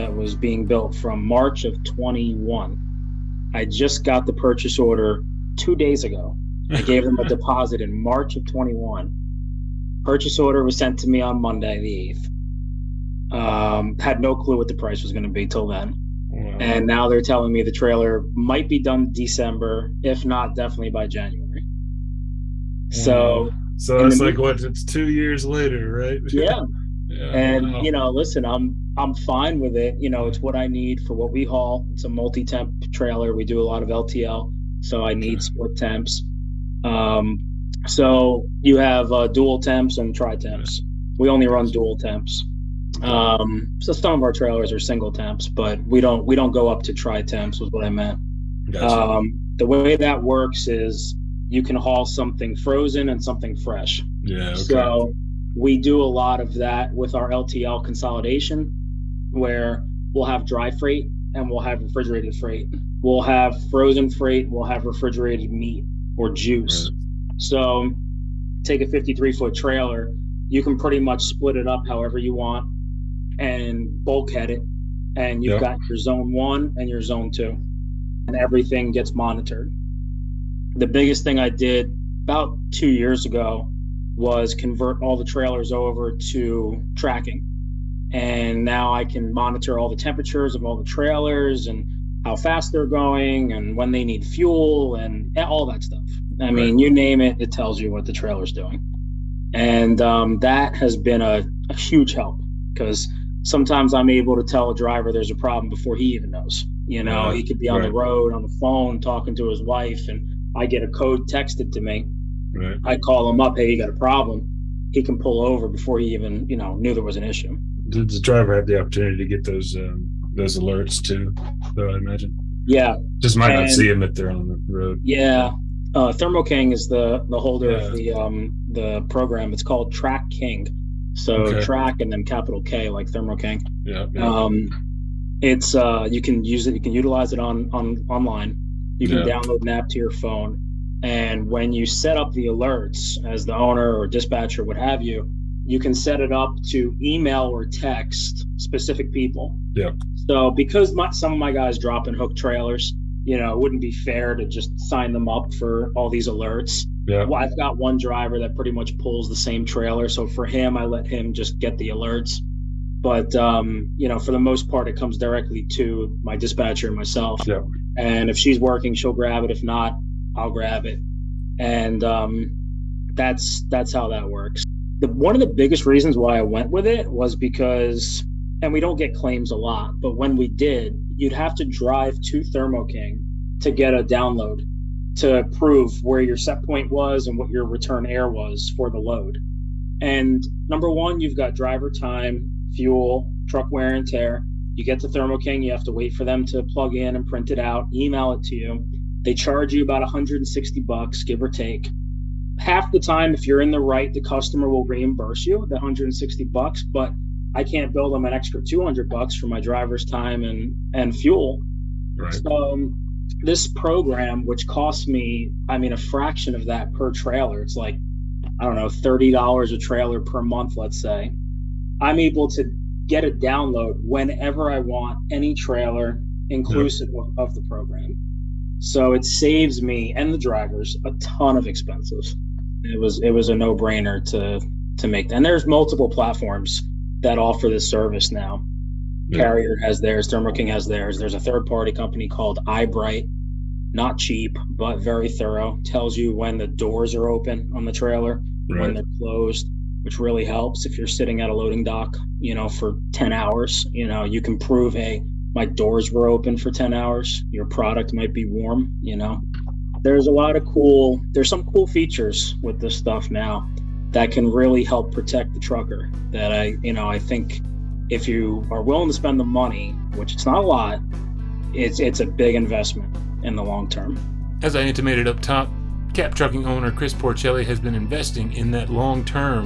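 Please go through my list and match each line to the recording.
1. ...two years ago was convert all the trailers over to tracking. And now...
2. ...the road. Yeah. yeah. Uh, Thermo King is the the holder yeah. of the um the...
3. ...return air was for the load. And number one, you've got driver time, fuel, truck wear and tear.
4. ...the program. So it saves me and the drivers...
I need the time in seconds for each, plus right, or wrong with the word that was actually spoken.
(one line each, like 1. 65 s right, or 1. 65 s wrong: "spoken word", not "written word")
1. 82 s right
2. 124 s right
3. 187 s right
4. 227 s right.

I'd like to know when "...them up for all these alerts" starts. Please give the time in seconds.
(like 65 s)
155 s.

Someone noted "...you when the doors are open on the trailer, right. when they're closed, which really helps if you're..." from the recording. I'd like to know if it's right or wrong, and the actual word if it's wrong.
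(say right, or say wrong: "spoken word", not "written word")
right.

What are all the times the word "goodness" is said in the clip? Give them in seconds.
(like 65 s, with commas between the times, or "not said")
not said.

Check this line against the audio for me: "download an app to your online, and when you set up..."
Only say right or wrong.
wrong.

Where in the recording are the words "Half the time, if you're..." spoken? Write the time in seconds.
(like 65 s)
202 s.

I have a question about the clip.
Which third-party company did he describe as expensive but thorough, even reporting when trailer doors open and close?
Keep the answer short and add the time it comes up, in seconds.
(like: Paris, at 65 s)
iBright, at 242 s.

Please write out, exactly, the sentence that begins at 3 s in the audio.
I just got the purchase order two days ago.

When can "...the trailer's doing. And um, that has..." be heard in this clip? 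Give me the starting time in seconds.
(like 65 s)
98 s.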